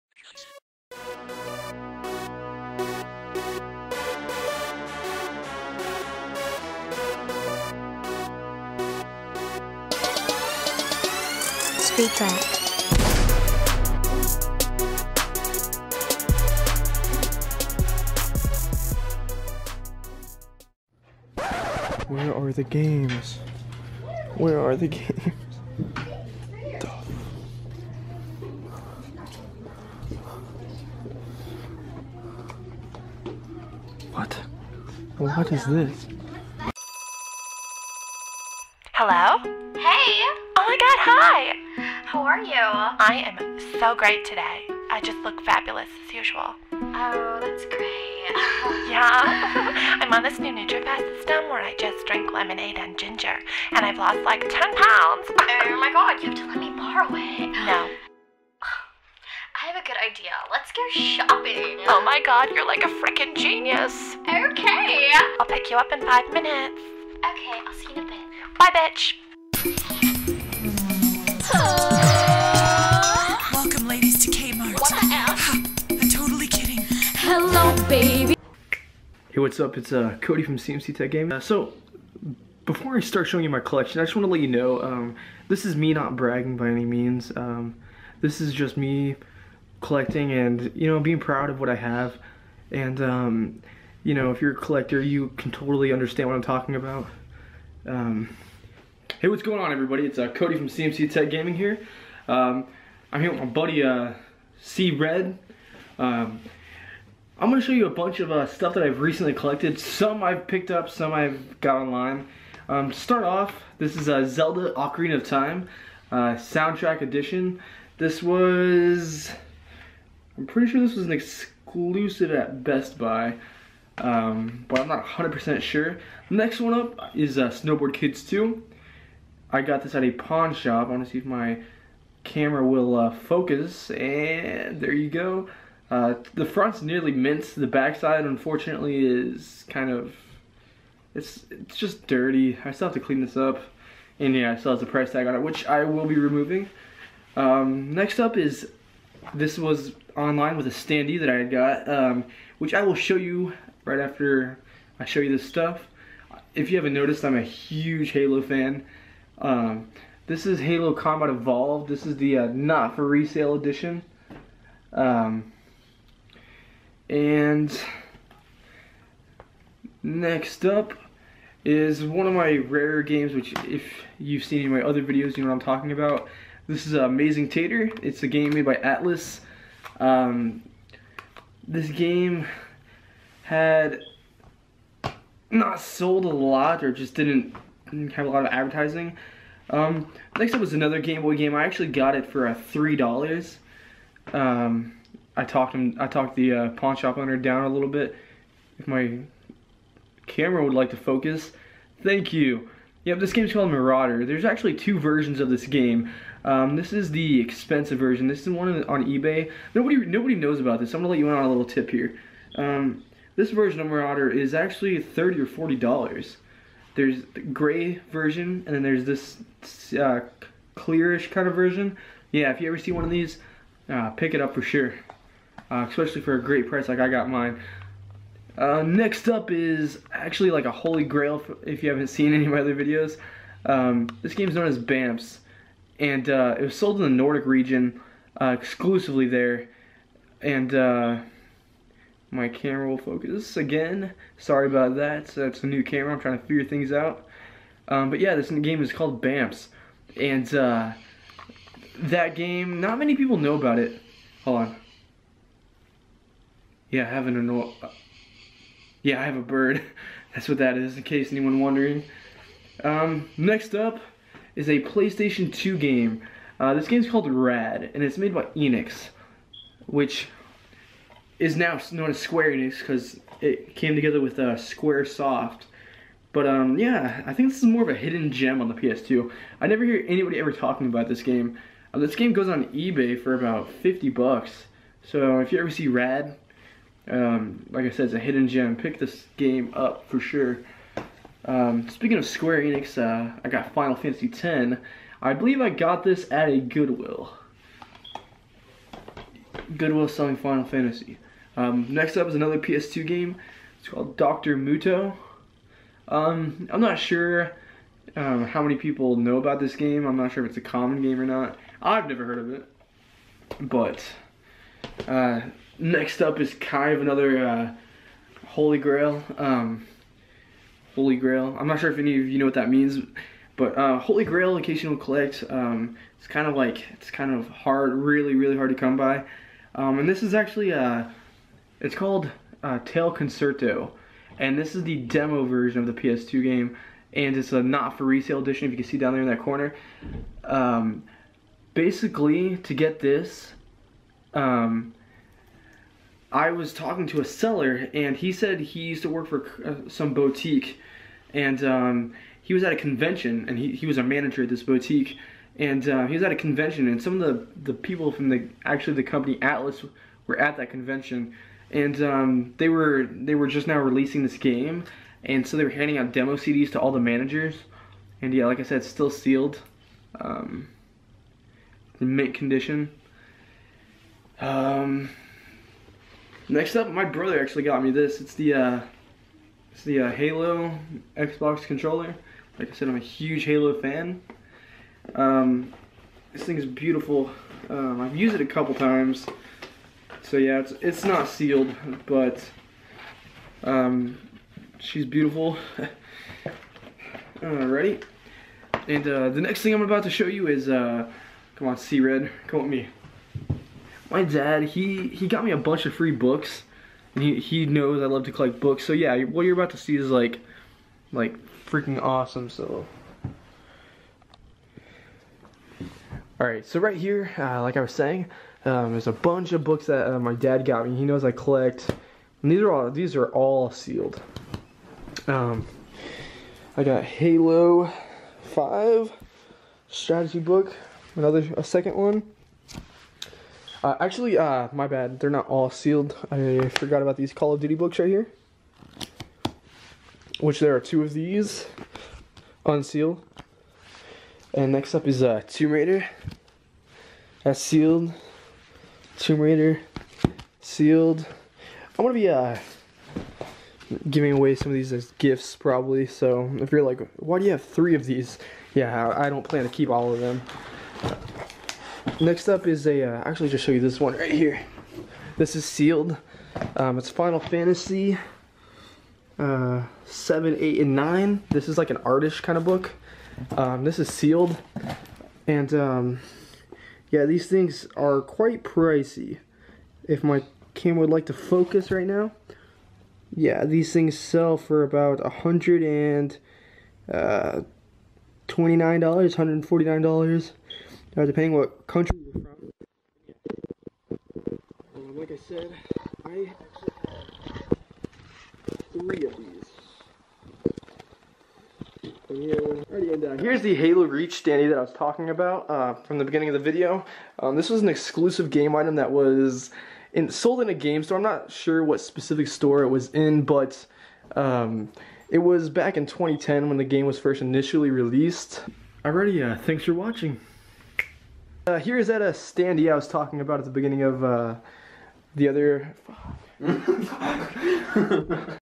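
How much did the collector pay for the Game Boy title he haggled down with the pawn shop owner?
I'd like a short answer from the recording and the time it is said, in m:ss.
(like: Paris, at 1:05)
$3, at 3:12.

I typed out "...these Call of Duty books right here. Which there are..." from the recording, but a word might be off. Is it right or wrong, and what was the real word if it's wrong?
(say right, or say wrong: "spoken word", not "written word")
right.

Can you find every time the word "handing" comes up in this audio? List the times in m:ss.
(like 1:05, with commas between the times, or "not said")
6:05.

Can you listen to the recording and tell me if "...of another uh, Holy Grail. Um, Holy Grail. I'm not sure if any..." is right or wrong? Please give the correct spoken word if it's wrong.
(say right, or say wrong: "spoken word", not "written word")
right.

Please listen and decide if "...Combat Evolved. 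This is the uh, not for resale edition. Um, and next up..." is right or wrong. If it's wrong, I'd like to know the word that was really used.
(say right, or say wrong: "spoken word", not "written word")
right.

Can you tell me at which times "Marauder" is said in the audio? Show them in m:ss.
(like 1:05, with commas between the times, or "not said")
3:23, 3:33.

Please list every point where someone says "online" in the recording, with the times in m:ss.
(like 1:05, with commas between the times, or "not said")
1:51, 2:30.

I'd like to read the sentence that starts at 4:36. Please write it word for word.
But um, yeah, I think this is more of a hidden gem on the PS2.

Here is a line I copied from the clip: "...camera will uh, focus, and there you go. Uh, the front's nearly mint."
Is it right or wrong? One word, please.
right.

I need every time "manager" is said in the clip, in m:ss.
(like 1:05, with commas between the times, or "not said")
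5:54, 6:06.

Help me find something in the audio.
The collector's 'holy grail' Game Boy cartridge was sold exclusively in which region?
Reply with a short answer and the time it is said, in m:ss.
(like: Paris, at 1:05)
Nordic region, at 3:57.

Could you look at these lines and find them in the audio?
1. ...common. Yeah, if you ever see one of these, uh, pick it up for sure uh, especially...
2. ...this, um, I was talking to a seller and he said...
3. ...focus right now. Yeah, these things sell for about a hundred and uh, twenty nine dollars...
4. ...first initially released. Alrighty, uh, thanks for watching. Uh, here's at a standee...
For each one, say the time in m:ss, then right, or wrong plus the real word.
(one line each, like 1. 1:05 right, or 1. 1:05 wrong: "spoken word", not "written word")
1. 3:41 wrong: "version", not "common"
2. 5:42 right
3. 8:01 right
4. 8:37 right.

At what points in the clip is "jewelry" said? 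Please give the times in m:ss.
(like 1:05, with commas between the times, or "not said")
not said.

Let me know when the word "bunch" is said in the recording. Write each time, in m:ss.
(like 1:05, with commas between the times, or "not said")
1:47, 6:45, 6:59.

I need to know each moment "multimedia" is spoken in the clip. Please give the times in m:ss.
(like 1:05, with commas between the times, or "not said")
not said.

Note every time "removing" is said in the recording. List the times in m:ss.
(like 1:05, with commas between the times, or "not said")
2:26.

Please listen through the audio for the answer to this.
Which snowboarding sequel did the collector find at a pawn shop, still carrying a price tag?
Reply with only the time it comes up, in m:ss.
2:07.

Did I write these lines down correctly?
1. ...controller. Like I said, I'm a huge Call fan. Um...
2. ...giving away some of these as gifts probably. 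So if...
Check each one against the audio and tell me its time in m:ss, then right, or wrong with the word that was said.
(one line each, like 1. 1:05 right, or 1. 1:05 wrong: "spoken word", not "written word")
1. 6:21 wrong: "Halo", not "Call"
2. 7:34 right.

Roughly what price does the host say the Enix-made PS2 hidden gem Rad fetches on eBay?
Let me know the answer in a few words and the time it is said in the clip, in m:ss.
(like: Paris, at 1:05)
$50, at 4:43.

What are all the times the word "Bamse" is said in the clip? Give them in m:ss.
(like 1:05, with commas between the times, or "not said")
3:54, 4:09.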